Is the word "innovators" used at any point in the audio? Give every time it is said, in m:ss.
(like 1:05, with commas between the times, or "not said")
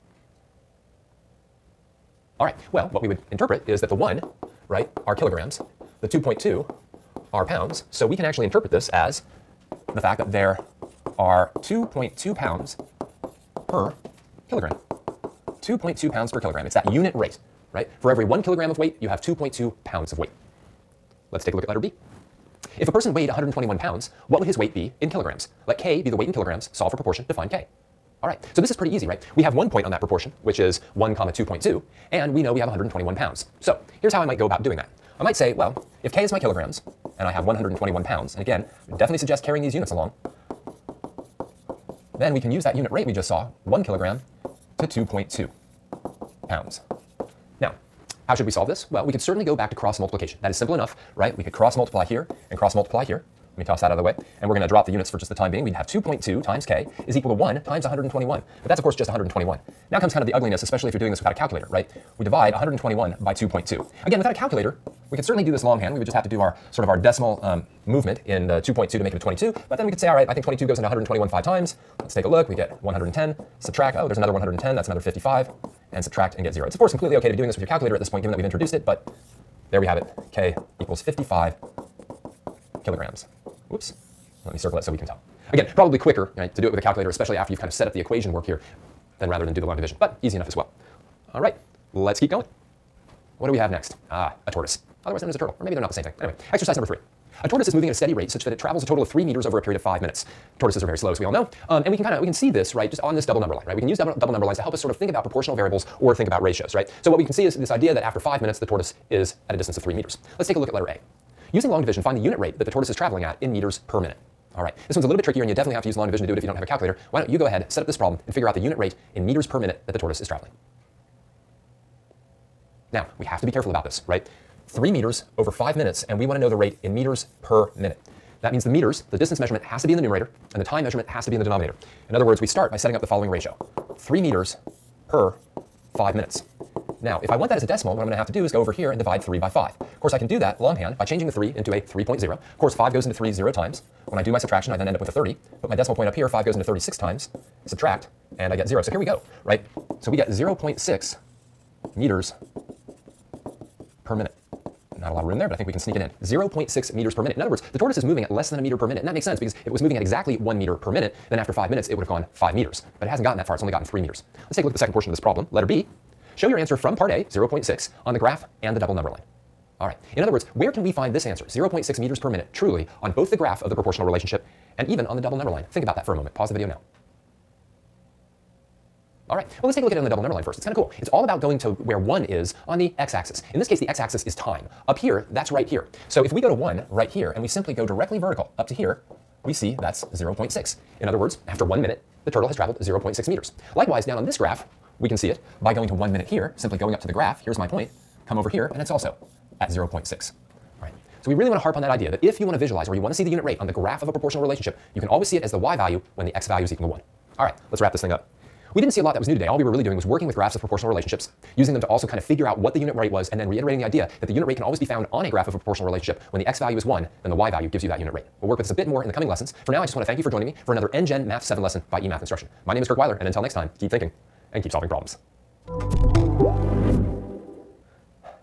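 not said.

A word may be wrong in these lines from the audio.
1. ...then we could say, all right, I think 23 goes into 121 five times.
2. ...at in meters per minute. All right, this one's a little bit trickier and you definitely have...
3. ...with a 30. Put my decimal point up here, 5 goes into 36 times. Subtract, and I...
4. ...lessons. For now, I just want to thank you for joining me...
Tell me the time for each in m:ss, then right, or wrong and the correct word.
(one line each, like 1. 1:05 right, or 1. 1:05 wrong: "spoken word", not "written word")
1. 1:09 wrong: "22", not "23"
2. 1:53 right
3. 2:25 right
4. 3:39 right.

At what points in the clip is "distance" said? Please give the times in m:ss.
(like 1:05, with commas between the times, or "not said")
1:49, 2:09.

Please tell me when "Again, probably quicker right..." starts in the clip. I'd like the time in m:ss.
1:25.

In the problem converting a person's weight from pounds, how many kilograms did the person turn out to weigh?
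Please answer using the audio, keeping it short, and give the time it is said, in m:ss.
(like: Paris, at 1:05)
55 kilograms, at 1:20.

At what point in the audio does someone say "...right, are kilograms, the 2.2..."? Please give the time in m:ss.
0:04.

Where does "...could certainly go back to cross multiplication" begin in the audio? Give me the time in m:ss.
0:49.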